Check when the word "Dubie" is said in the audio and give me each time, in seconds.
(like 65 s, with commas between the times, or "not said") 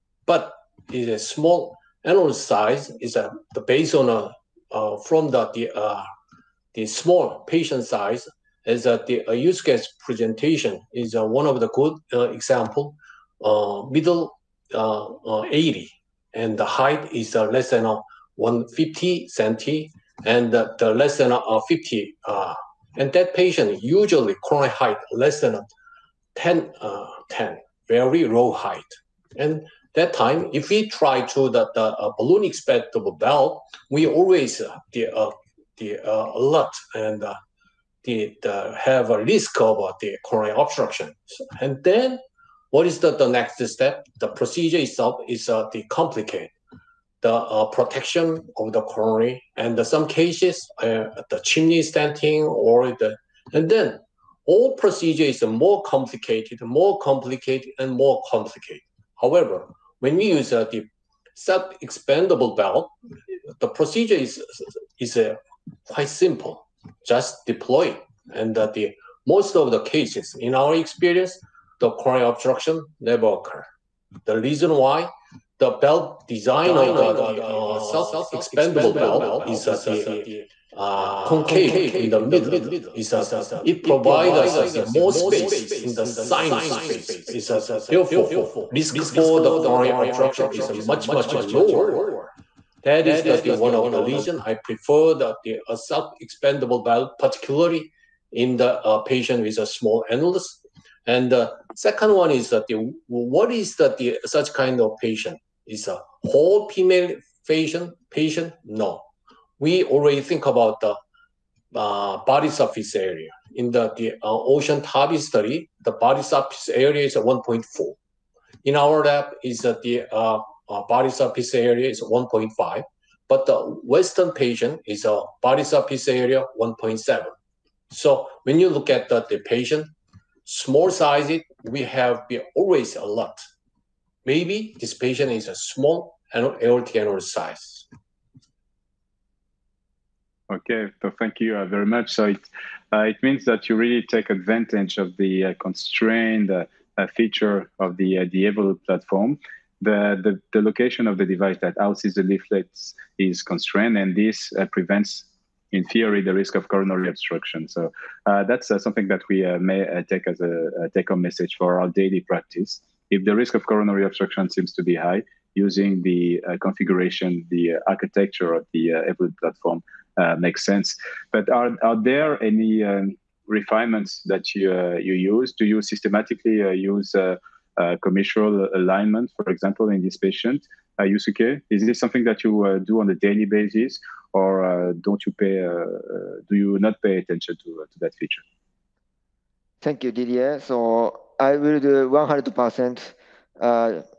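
not said.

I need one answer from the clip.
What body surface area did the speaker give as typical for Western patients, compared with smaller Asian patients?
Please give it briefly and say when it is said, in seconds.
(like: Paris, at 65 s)
1.7, at 126 s.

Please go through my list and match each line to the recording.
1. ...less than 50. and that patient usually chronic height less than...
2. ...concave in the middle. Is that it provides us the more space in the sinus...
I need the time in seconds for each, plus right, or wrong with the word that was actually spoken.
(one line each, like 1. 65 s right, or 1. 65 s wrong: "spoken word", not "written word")
1. 20 s right
2. 81 s right.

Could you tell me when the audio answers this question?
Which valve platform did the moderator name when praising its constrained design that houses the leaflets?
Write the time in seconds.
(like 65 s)
148 s.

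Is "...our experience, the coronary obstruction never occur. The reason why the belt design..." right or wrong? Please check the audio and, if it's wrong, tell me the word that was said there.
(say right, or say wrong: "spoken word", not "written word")
right.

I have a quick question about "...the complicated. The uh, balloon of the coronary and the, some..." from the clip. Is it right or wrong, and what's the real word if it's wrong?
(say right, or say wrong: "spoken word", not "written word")
wrong: "protection", not "balloon".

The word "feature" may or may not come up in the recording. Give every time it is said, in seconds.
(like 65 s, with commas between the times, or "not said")
147 s, 188 s.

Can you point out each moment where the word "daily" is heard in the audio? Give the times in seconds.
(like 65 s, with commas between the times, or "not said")
161 s, 183 s.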